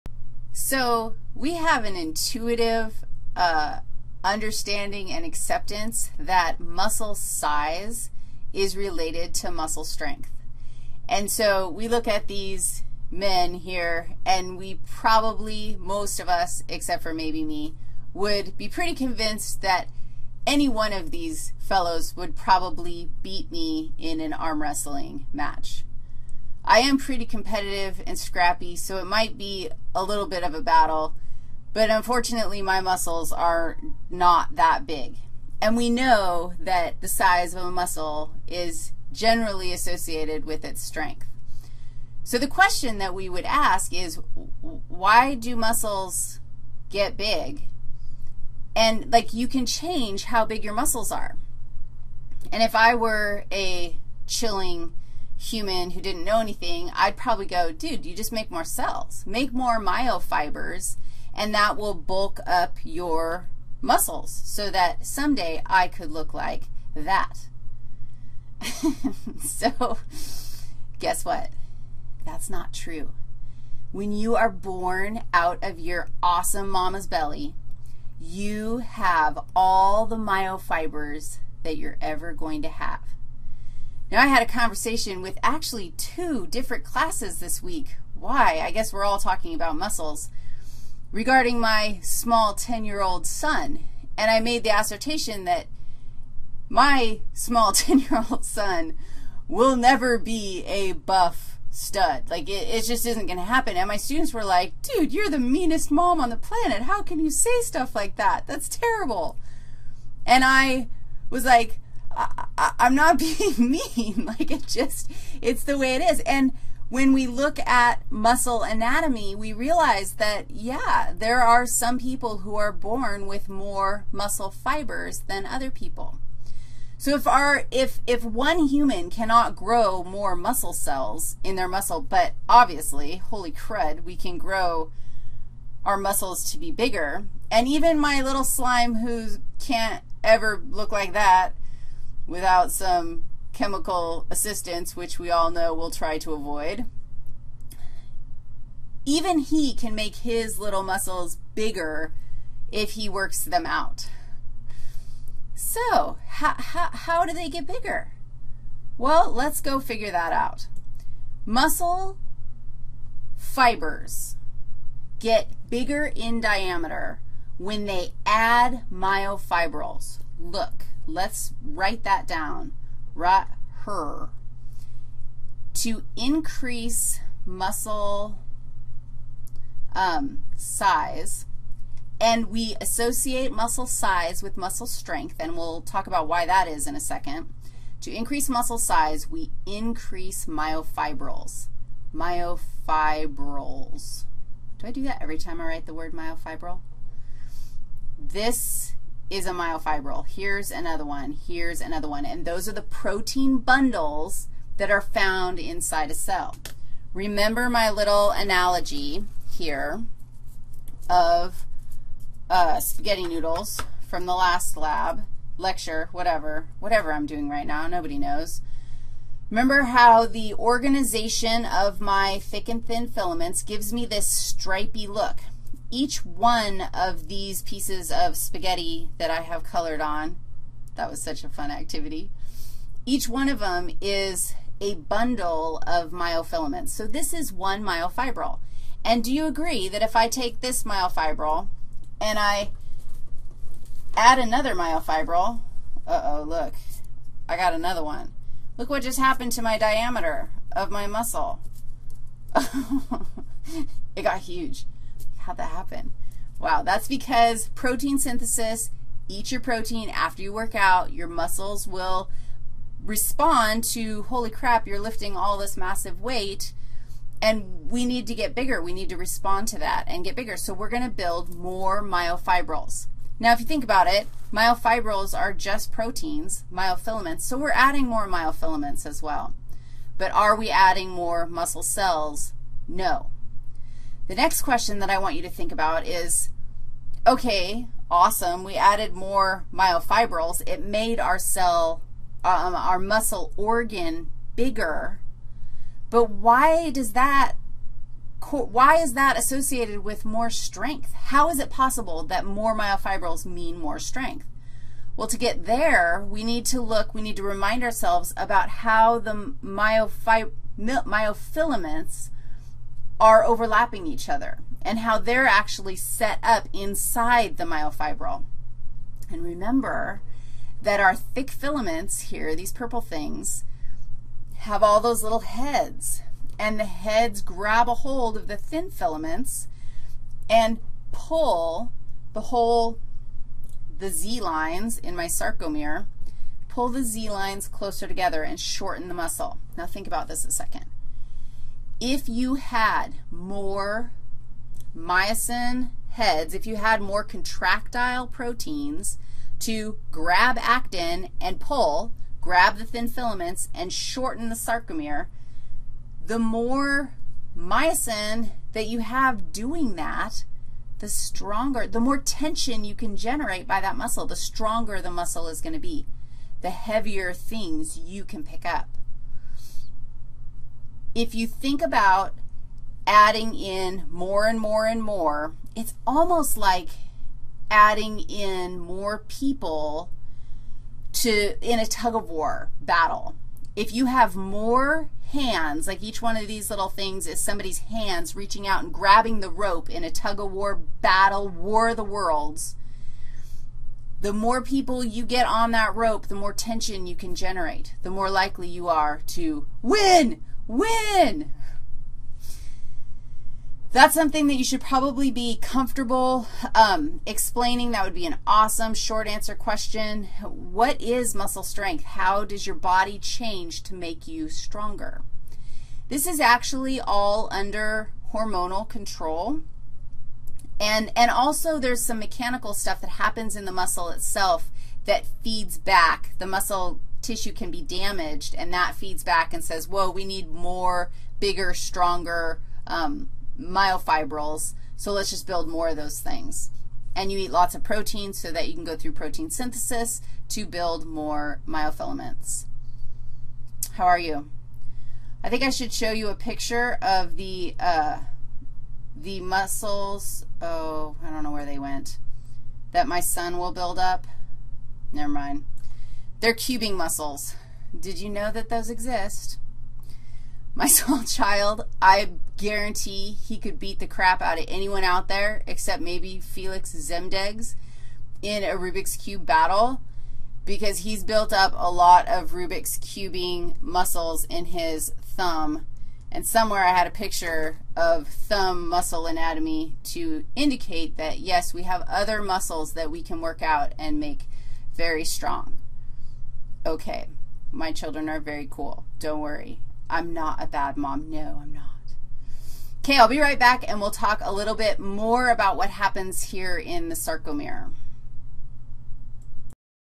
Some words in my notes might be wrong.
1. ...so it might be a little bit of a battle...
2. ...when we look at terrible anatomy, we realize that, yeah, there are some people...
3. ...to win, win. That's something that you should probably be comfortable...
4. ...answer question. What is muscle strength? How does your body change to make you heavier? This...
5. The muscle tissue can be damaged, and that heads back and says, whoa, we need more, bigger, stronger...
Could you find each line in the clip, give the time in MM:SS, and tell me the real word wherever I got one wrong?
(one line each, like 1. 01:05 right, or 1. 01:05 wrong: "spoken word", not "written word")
1. 00:28 right
2. 01:56 wrong: "muscle", not "terrible"
3. 06:39 right
4. 06:49 wrong: "stronger", not "heavier"
5. 07:06 wrong: "feeds", not "heads".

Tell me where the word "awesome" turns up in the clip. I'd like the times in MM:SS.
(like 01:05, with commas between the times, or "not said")
01:16, 04:48, 06:48.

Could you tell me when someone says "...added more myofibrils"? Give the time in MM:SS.
04:48.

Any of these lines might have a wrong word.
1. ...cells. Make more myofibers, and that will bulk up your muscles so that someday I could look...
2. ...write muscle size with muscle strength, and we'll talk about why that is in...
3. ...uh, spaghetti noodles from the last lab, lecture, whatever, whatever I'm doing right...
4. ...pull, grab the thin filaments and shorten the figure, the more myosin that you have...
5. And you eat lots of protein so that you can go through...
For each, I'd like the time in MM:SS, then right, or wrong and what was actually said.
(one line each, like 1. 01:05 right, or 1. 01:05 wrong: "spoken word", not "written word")
1. 00:58 right
2. 03:02 wrong: "associate", not "write"
3. 03:32 right
4. 05:51 wrong: "sarcomere", not "figure"
5. 07:17 right.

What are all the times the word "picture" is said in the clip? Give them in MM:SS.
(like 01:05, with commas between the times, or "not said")
07:26, 07:57.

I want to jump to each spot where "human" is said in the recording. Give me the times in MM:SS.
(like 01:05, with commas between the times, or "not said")
00:55, 02:08.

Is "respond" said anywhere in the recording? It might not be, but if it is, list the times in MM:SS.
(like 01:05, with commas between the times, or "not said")
04:23, 04:29.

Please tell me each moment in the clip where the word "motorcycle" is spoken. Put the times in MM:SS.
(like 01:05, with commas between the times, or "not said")
not said.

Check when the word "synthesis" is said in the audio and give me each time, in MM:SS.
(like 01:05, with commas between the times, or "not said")
04:18, 07:19.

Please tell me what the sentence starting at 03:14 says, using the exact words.
Do I do that every time I write the word myofibril?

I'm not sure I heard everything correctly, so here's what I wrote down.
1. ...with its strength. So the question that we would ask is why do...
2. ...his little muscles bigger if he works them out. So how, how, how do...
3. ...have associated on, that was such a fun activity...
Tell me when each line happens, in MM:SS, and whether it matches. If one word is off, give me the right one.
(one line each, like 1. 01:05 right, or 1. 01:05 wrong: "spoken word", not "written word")
1. 00:40 right
2. 02:30 right
3. 03:49 wrong: "colored", not "associated".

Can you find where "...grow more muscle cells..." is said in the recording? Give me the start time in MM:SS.
02:09.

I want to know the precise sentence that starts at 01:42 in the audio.
Like, it, it just isn't going to happen.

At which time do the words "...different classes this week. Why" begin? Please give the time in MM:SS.
01:26.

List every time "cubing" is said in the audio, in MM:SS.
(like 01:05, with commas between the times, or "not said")
07:36, 07:52.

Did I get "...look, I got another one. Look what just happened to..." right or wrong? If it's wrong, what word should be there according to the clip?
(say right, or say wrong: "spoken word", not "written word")
right.